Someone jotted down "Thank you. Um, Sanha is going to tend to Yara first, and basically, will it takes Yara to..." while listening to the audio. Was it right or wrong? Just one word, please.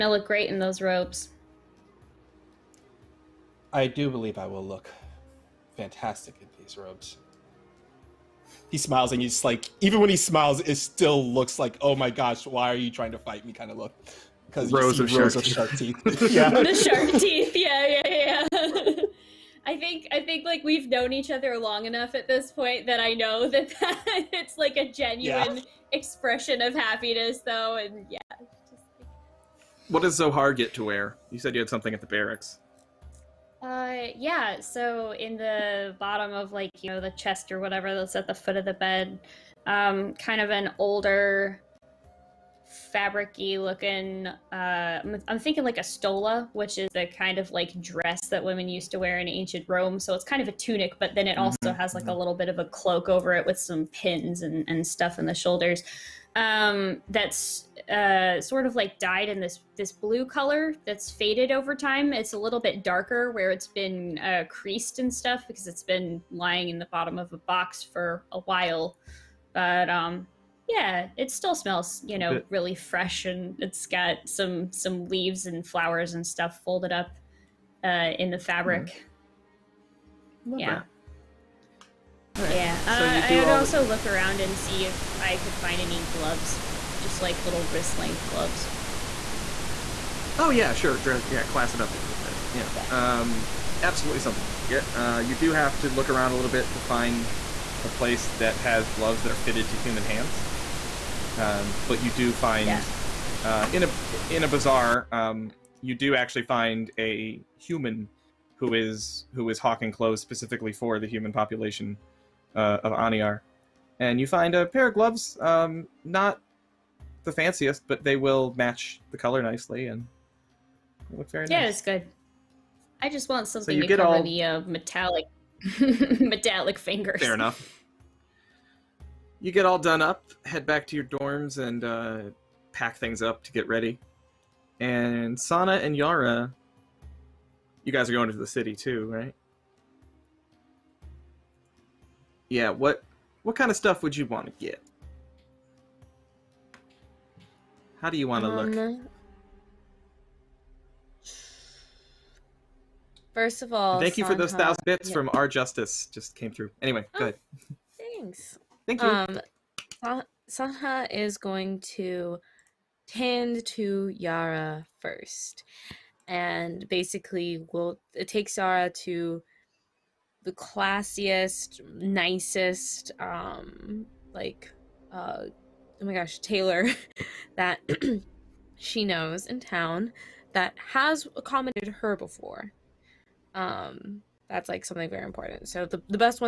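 right.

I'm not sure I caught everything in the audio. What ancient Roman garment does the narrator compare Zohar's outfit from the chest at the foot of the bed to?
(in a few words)
stola.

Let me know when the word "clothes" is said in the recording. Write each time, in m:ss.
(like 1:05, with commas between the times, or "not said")
1:49.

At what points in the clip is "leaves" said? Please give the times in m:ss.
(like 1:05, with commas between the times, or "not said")
1:15.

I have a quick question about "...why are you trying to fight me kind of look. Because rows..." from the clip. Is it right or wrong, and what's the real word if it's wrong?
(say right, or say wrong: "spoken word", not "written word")
right.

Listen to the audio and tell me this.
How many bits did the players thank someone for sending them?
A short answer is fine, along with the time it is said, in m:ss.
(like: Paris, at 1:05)
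1000, at 2:34.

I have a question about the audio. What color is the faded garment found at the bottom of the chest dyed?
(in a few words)
blue.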